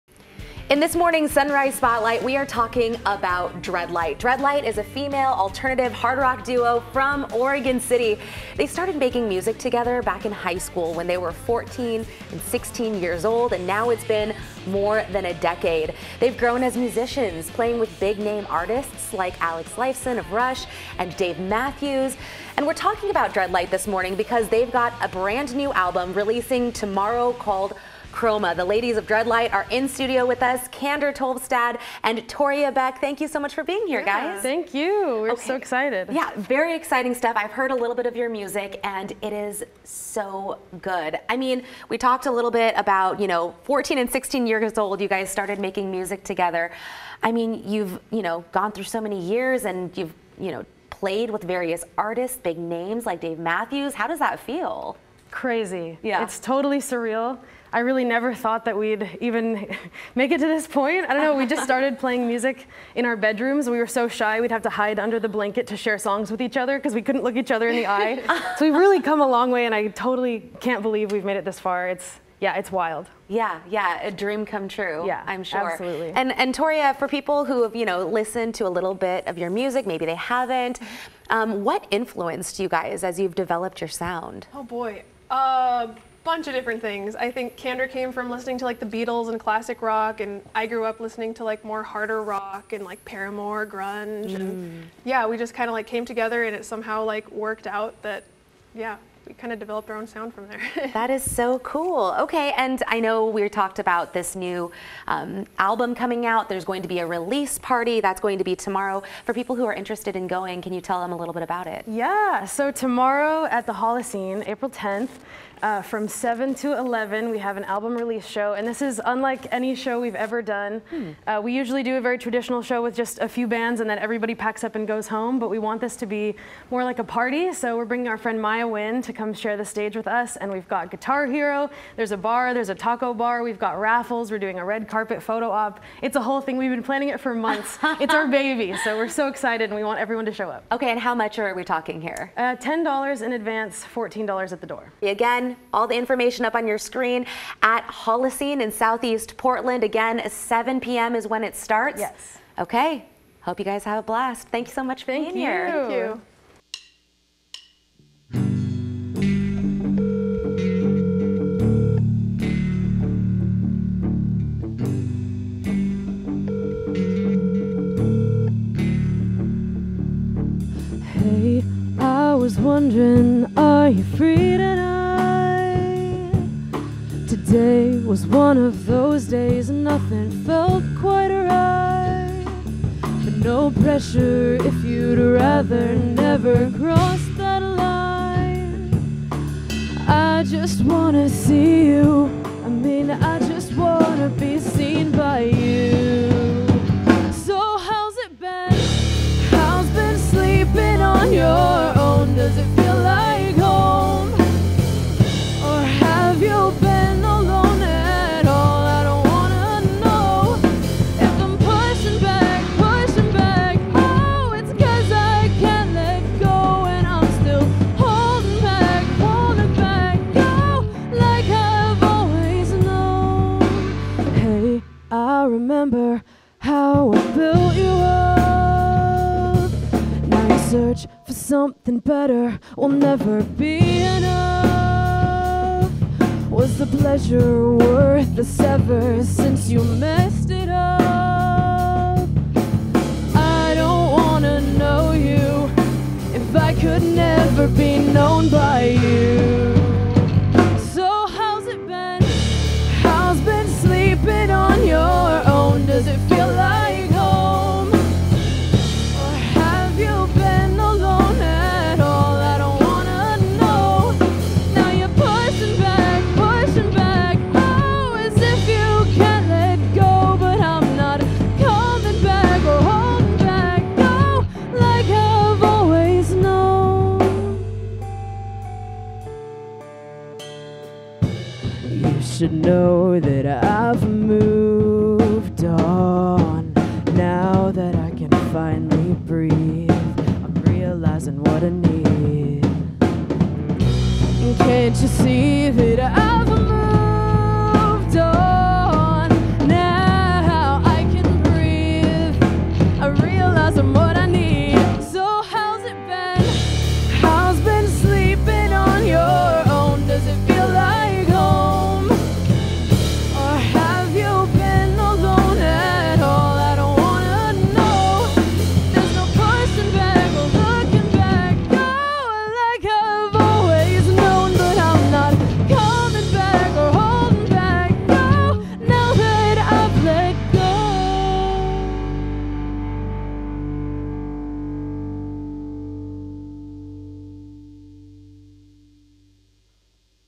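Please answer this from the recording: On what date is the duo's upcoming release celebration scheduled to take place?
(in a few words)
April 10th.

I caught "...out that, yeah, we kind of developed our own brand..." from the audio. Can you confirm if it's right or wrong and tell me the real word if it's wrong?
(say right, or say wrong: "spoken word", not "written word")
wrong: "sound", not "brand".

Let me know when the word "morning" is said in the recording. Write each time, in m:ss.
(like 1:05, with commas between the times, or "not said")
0:00, 0:23.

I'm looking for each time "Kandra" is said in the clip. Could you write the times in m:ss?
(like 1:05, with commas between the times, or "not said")
0:30, 1:27.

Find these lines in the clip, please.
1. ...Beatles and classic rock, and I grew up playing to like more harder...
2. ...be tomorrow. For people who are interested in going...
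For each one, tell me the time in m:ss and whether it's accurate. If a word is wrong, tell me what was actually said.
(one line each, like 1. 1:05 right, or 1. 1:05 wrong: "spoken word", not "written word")
1. 1:28 wrong: "listening", not "playing"
2. 1:48 right.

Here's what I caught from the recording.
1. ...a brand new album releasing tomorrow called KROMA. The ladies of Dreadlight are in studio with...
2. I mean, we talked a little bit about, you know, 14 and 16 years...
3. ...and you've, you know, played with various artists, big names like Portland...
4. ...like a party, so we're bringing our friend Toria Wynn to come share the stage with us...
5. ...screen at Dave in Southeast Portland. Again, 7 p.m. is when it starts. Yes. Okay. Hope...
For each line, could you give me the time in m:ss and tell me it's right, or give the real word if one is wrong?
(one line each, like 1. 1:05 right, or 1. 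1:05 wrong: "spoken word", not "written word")
1. 0:25 right
2. 0:41 right
3. 0:49 wrong: "Dave", not "Portland"
4. 2:06 wrong: "Maya", not "Toria"
5. 2:26 wrong: "Holocene", not "Dave".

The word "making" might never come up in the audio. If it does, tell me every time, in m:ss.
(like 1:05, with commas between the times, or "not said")
0:08, 0:45.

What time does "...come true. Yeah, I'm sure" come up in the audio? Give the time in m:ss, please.
1:14.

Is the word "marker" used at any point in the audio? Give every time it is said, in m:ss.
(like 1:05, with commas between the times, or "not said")
not said.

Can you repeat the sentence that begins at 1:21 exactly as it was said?
Um, what influenced you guys as you've developed your sound?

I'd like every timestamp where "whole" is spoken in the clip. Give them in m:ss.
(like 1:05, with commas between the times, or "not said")
2:16.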